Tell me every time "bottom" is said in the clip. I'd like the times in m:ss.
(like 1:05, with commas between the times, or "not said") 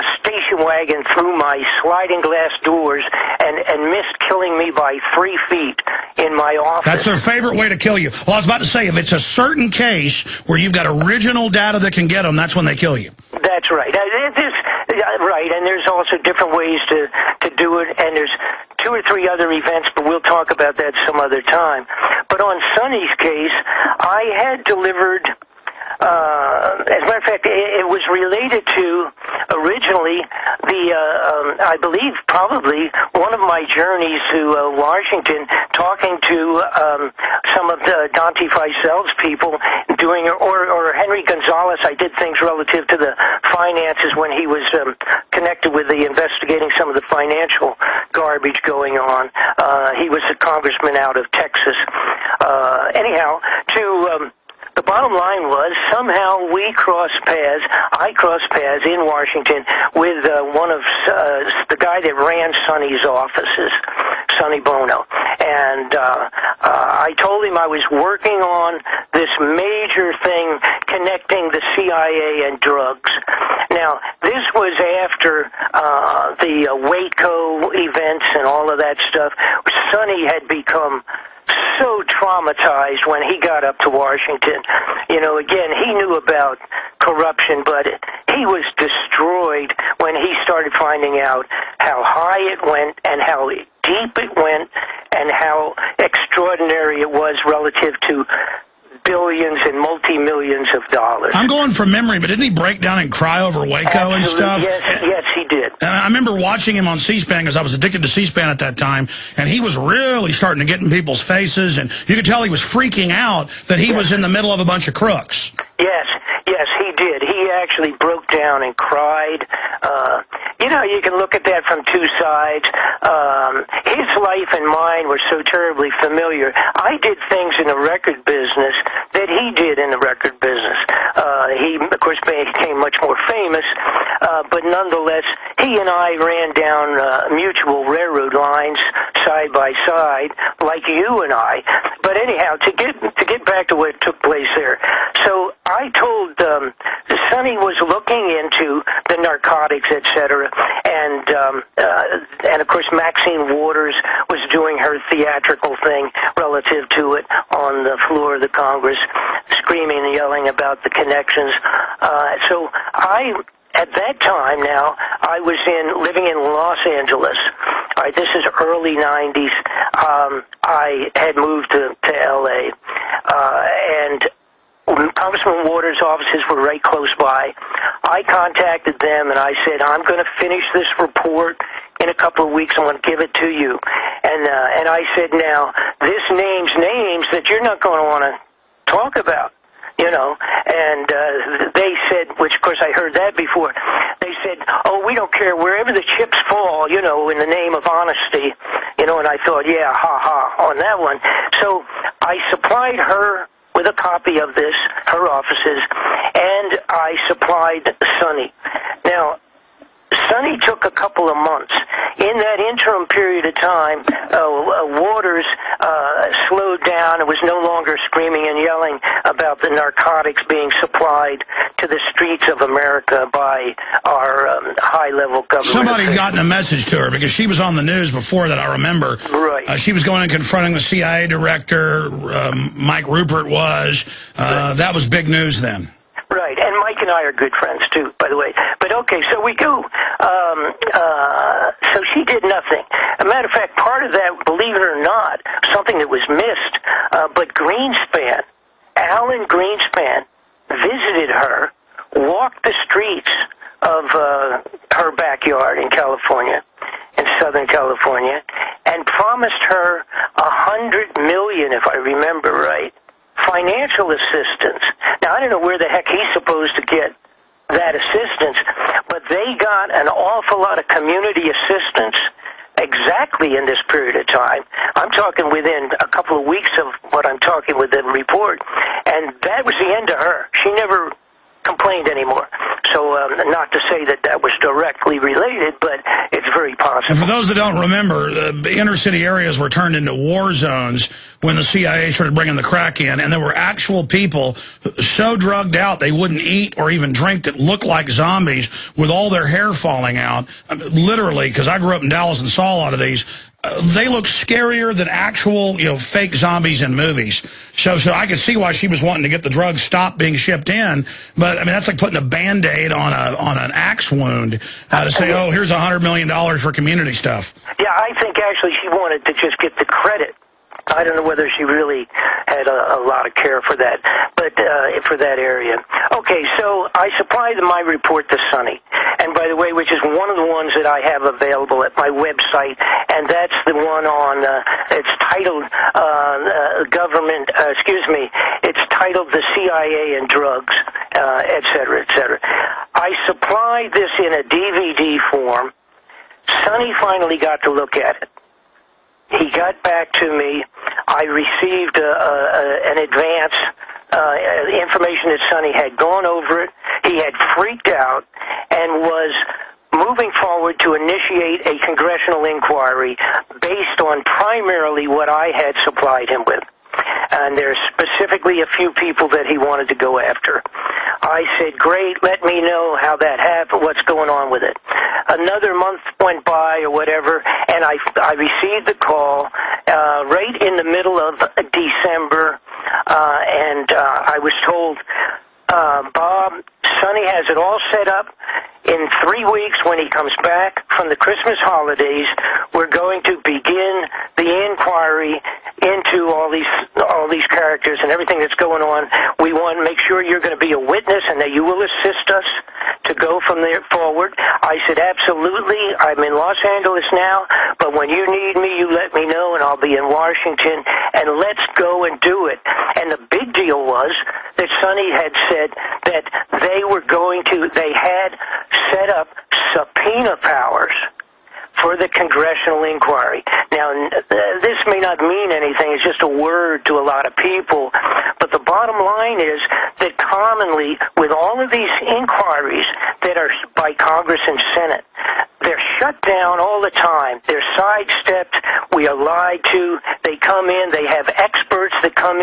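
0:54, 7:08.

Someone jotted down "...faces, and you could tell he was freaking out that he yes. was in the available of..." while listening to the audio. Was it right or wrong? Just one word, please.
wrong.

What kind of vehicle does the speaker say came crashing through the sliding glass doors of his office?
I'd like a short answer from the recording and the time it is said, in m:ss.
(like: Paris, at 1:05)
station wagon, at 0:00.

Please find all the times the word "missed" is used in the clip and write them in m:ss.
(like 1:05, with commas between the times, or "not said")
0:03, 4:06.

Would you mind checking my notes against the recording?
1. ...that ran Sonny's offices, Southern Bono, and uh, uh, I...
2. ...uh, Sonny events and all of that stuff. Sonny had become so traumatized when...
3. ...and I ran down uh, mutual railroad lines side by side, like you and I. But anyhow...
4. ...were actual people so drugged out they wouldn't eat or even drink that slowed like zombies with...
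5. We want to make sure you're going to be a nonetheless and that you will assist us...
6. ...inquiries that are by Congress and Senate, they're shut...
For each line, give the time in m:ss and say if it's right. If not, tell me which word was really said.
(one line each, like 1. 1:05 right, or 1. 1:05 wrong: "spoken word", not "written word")
1. 1:02 wrong: "Sonny", not "Southern"
2. 1:16 wrong: "Waco", not "Sonny"
3. 2:15 right
4. 4:53 wrong: "looked", not "slowed"
5. 6:39 wrong: "witness", not "nonetheless"
6. 7:12 right.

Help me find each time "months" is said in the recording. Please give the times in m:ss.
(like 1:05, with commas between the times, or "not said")
3:31, 6:15.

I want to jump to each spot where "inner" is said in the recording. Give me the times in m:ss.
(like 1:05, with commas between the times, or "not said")
4:48.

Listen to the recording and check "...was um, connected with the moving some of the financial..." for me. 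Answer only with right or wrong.
wrong.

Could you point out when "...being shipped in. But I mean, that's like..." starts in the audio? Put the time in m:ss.
5:10.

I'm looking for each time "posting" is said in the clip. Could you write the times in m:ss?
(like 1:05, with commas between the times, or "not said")
not said.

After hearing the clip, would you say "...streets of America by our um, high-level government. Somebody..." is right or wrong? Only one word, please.
right.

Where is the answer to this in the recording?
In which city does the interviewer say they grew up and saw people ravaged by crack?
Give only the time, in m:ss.
5:02.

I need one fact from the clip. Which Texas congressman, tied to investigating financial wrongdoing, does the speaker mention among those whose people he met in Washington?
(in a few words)
Henry Gonzalez.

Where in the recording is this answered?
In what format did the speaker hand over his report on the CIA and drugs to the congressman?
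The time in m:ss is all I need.
5:44.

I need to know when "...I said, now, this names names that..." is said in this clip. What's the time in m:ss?
3:04.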